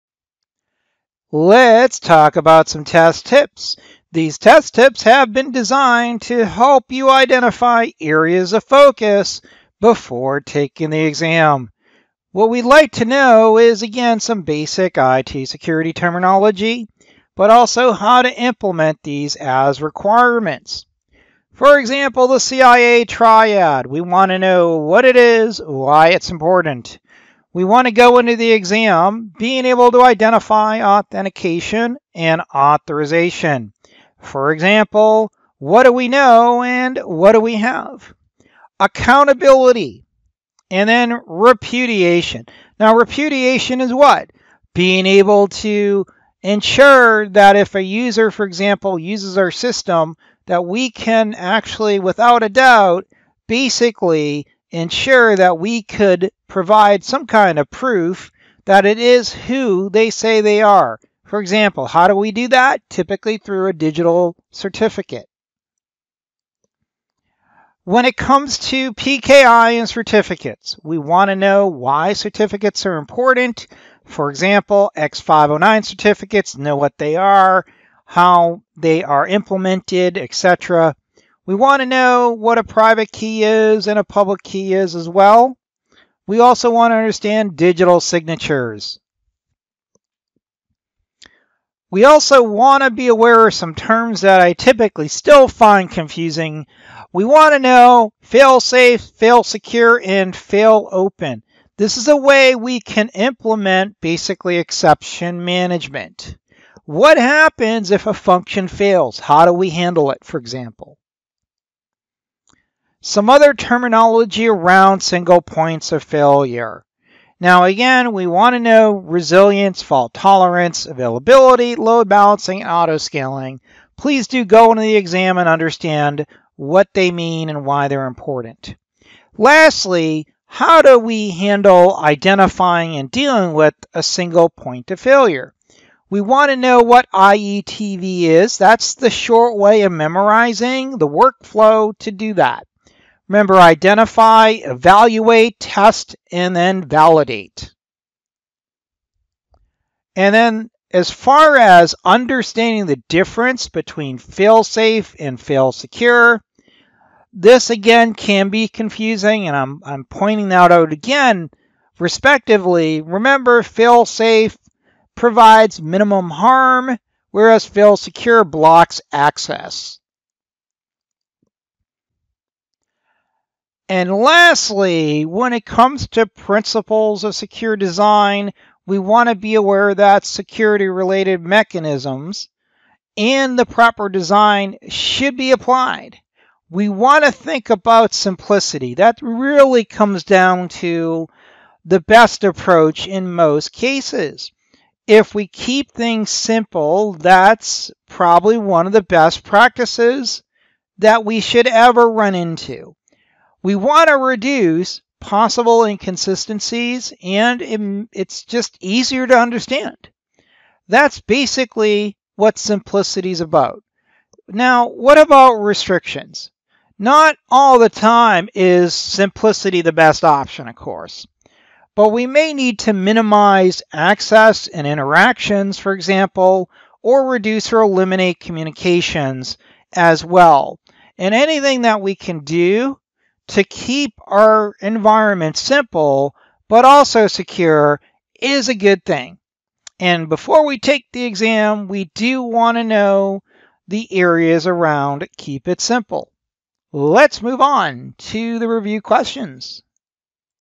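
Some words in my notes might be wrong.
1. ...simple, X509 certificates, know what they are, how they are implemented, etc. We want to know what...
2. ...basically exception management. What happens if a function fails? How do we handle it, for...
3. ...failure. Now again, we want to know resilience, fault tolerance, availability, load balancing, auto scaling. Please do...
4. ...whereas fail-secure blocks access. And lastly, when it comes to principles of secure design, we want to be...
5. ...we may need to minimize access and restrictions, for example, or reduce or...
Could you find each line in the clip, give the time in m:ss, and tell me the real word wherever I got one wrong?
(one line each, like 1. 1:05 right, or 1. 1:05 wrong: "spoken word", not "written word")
1. 1:14 wrong: "example", not "simple"
2. 1:43 right
3. 1:56 right
4. 2:47 right
5. 3:42 wrong: "interactions", not "restrictions".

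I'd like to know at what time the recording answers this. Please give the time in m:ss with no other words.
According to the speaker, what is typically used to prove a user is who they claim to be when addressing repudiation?
1:03.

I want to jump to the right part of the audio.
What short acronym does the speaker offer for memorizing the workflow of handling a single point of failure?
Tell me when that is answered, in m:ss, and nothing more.
2:17.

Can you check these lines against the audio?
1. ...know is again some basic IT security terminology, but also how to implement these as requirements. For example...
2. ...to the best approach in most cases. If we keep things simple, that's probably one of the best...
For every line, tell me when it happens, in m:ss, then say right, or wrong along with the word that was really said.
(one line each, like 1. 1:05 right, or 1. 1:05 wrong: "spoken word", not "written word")
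1. 0:13 right
2. 3:10 right.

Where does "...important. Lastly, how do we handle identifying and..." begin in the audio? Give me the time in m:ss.
2:08.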